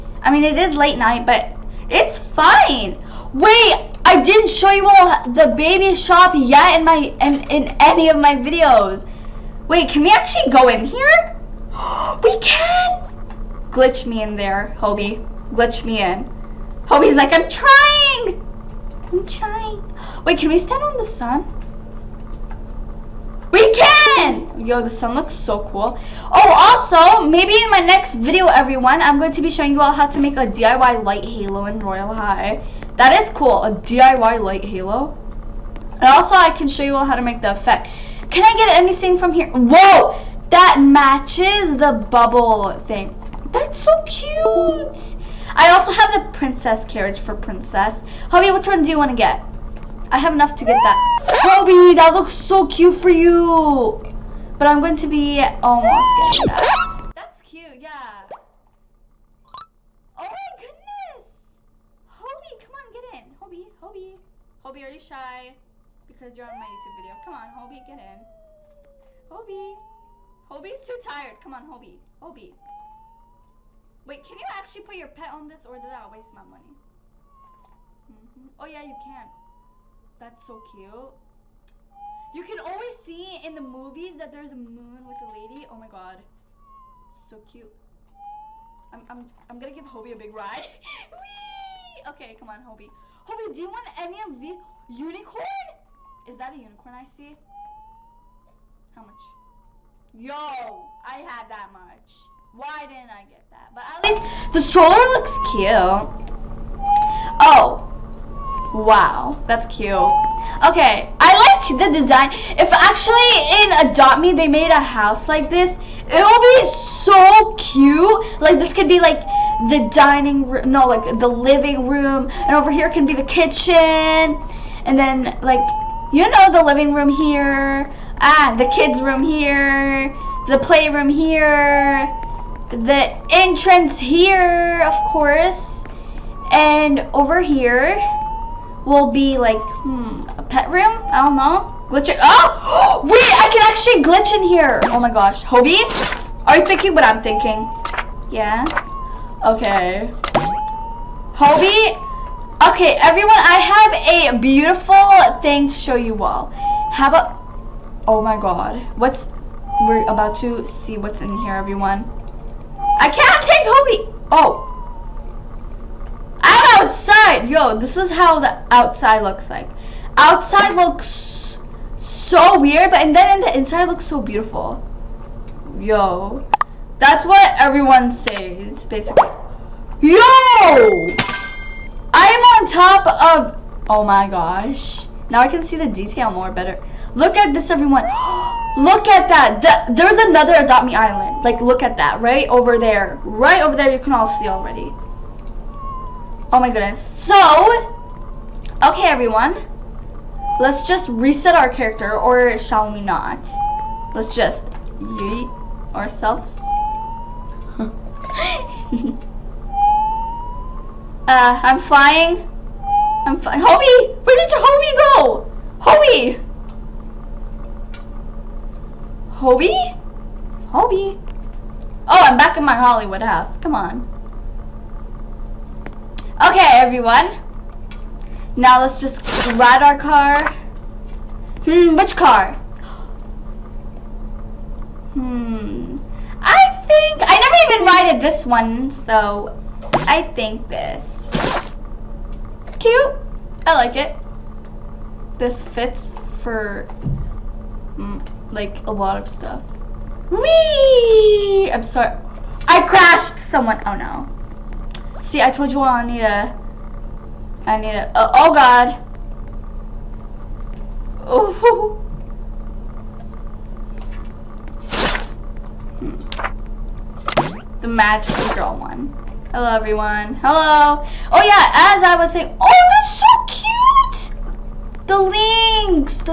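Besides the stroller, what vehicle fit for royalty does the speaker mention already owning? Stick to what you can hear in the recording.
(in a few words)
Princess carriage.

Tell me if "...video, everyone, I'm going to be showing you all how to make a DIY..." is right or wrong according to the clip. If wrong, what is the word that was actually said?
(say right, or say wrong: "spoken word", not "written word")
right.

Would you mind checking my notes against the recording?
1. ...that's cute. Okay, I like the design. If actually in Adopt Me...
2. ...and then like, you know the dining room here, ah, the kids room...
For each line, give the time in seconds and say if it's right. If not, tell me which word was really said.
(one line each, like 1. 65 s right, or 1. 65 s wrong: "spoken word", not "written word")
1. 109 s right
2. 124 s wrong: "living", not "dining".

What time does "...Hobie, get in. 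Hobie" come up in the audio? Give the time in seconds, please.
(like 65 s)
67 s.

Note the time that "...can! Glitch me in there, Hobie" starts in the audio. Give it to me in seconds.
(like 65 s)
12 s.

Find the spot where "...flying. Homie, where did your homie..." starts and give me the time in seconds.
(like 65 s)
213 s.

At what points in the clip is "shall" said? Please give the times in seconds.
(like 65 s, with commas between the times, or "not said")
202 s.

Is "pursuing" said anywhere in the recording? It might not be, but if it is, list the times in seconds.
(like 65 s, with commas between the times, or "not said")
not said.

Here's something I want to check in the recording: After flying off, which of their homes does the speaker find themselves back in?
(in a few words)
Hollywood house.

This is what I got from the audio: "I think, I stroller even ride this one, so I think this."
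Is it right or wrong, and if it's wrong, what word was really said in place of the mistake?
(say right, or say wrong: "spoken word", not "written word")
wrong: "never", not "stroller".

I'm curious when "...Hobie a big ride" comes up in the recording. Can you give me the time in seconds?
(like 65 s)
89 s.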